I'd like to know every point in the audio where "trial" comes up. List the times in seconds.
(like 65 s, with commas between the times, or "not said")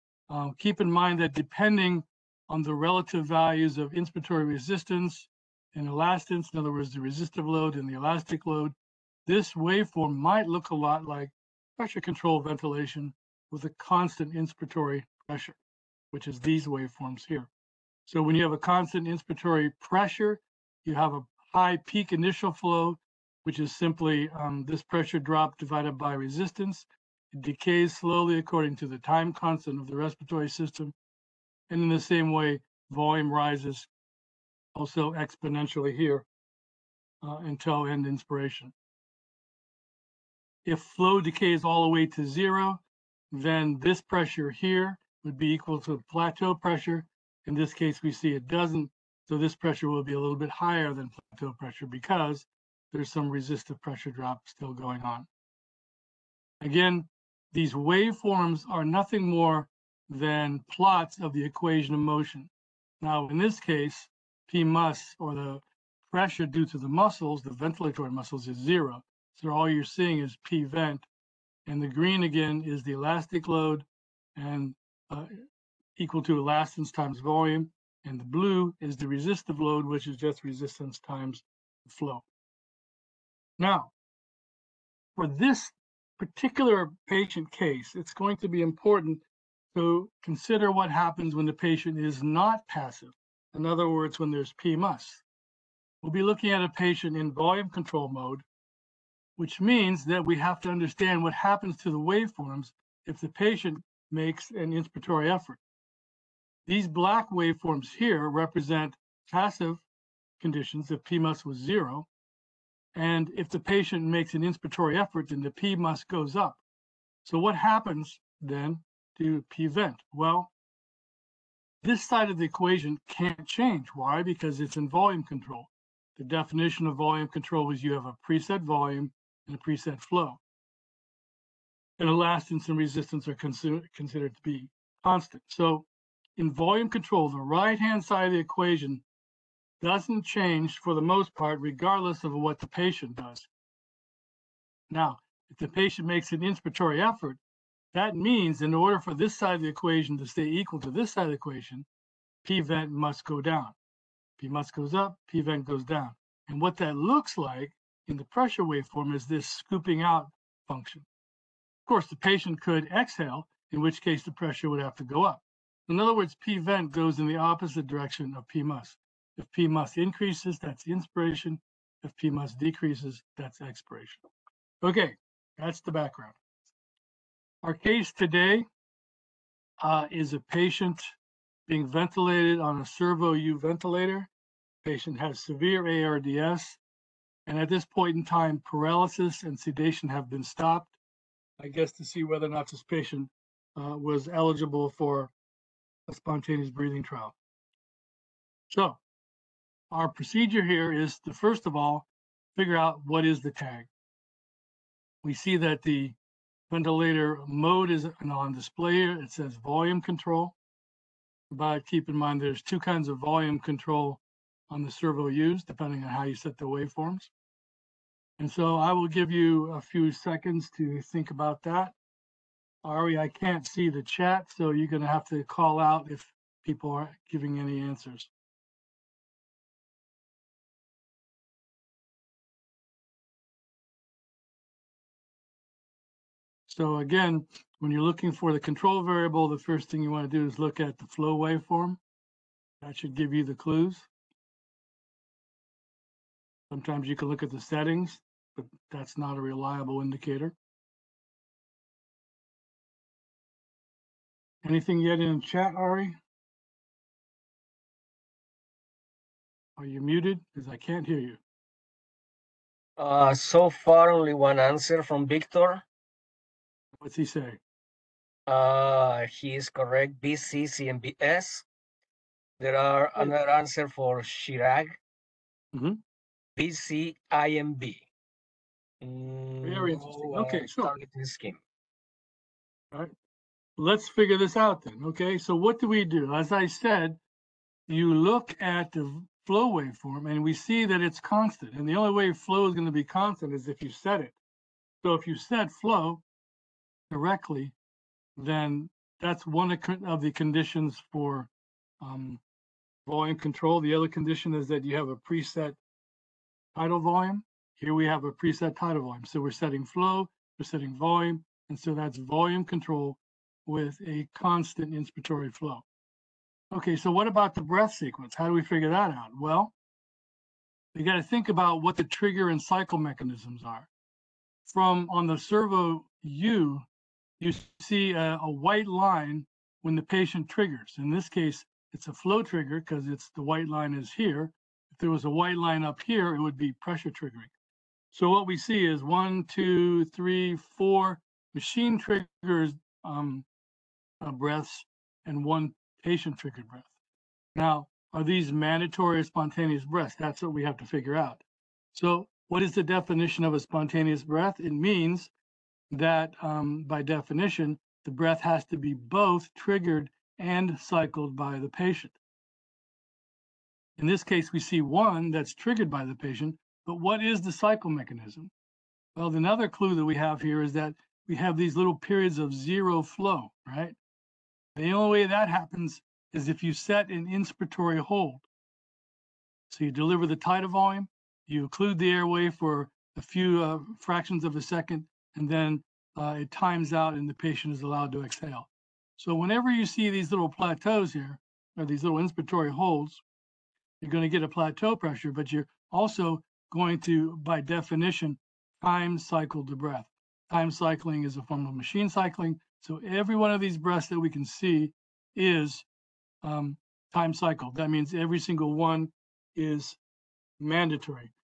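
197 s.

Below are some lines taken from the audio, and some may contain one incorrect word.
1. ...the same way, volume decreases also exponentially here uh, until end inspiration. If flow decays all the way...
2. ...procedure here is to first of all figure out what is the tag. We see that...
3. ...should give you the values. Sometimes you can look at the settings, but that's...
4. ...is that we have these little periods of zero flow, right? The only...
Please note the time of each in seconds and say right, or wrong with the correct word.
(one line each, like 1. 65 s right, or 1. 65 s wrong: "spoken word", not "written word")
1. 31 s wrong: "rises", not "decreases"
2. 200 s right
3. 242 s wrong: "clues", not "values"
4. 370 s right.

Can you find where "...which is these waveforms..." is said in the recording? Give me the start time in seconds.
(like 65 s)
16 s.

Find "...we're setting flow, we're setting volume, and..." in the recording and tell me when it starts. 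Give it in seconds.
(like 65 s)
309 s.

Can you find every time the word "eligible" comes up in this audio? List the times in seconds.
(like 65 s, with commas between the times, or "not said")
194 s.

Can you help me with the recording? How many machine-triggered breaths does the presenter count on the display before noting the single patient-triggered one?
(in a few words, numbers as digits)
4.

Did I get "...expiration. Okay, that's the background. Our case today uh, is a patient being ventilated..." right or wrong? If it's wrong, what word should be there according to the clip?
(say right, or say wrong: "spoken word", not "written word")
right.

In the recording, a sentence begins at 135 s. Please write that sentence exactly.
So in volume control, the right-hand side of the equation doesn't change for the most part, regardless of what the patient does.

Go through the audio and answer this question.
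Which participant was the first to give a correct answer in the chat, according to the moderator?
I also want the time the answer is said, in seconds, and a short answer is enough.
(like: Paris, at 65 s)
Victor, at 265 s.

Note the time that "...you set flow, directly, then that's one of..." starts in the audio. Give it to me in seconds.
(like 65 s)
295 s.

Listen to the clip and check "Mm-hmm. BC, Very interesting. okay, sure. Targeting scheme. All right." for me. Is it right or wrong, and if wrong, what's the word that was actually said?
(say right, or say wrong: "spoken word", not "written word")
right.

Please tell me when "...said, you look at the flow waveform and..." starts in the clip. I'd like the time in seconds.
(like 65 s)
286 s.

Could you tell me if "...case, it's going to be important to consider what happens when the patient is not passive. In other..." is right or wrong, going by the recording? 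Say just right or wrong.
right.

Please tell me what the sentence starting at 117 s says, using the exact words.
So what happens then to PVent?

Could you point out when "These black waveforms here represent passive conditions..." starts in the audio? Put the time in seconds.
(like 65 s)
106 s.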